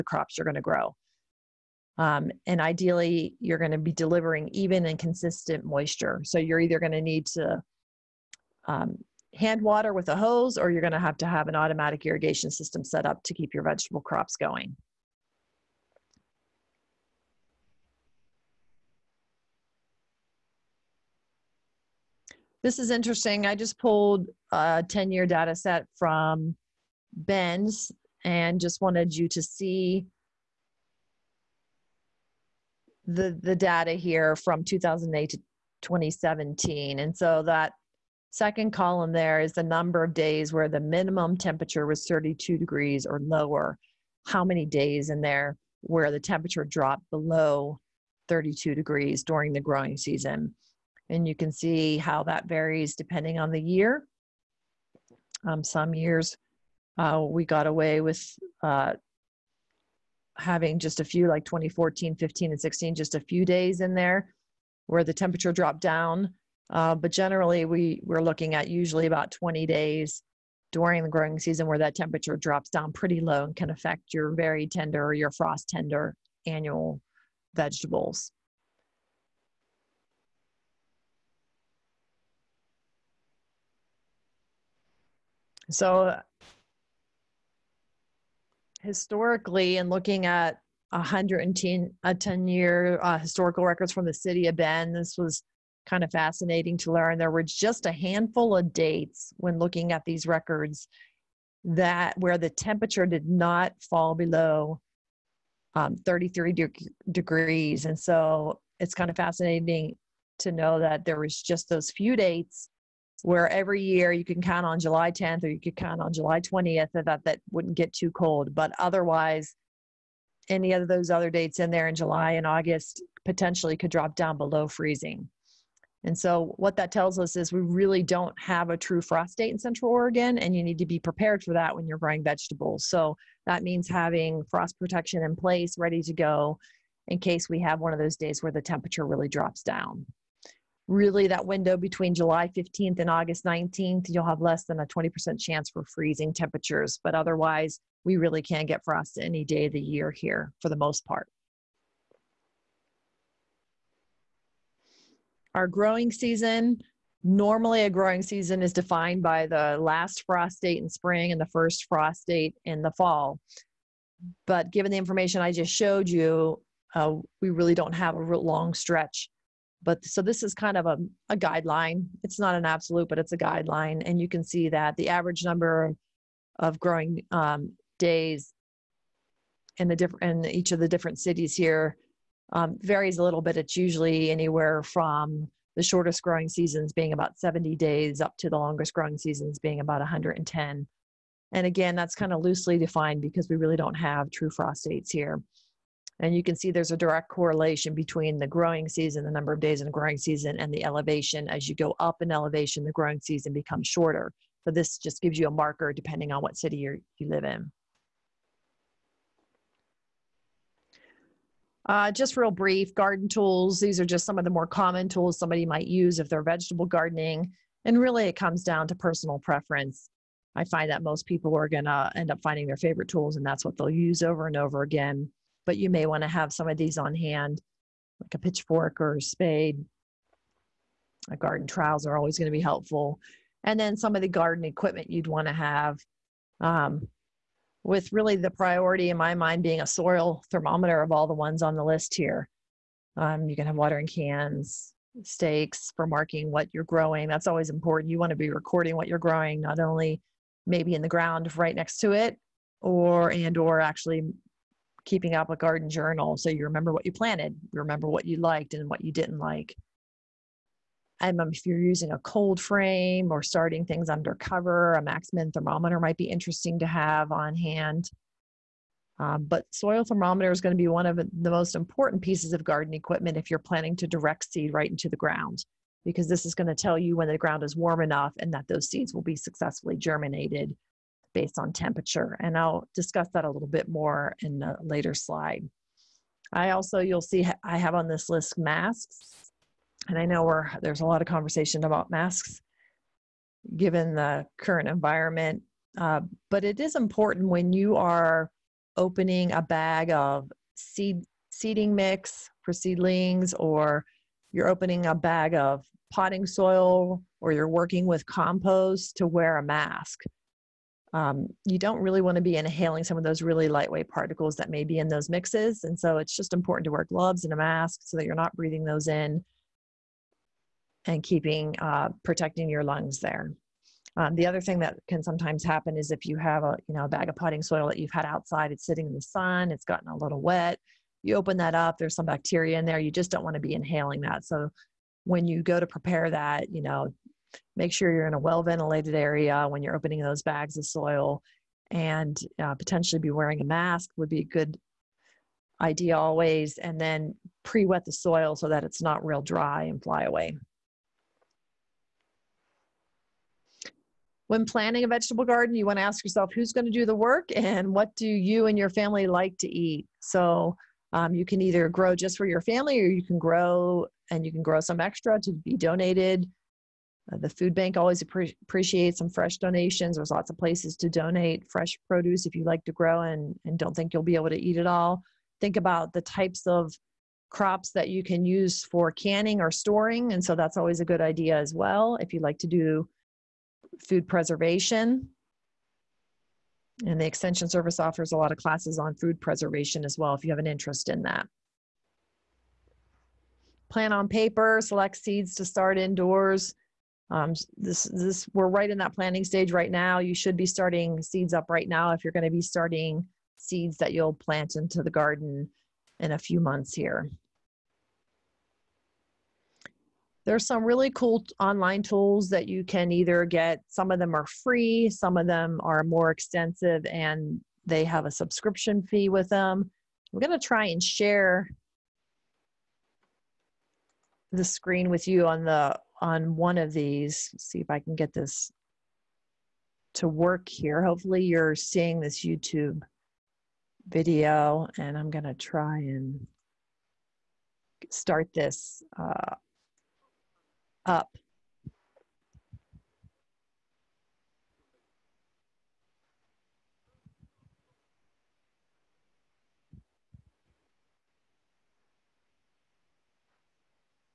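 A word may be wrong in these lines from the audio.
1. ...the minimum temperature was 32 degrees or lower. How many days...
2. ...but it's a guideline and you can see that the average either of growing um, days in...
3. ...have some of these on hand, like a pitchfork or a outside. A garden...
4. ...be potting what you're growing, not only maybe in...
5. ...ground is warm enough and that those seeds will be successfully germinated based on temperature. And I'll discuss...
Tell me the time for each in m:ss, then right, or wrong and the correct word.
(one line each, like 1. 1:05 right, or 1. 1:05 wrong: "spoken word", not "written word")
1. 0:40 right
2. 2:53 wrong: "number", not "either"
3. 3:46 wrong: "spade", not "outside"
4. 4:08 wrong: "recording", not "potting"
5. 4:37 right.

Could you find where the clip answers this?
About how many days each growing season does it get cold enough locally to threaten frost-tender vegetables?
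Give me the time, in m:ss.
1:09.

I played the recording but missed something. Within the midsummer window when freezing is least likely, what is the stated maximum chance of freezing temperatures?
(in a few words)
20%.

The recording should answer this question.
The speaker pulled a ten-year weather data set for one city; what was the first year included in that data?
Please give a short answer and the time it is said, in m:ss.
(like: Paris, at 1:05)
2008, at 0:34.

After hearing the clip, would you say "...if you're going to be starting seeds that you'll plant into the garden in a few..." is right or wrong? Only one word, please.
right.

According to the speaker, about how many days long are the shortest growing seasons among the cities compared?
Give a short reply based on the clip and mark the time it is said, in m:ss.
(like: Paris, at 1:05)
70 days, at 3:07.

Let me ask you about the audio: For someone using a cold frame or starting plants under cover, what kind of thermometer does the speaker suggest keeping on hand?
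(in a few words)
max-min thermometer.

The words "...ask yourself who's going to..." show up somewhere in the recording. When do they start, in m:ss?
5:56.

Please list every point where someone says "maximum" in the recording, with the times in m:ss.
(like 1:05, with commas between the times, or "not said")
not said.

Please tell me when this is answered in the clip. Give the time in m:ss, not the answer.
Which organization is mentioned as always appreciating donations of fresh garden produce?
6:07.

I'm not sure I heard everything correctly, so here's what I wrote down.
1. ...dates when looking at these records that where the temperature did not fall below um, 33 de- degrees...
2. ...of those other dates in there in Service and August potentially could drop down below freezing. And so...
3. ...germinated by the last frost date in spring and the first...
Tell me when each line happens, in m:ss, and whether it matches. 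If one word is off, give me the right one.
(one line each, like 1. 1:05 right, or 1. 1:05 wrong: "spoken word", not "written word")
1. 1:38 right
2. 2:00 wrong: "July", not "Service"
3. 2:38 wrong: "defined", not "germinated".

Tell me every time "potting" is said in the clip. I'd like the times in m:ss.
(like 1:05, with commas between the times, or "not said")
5:06, 5:27.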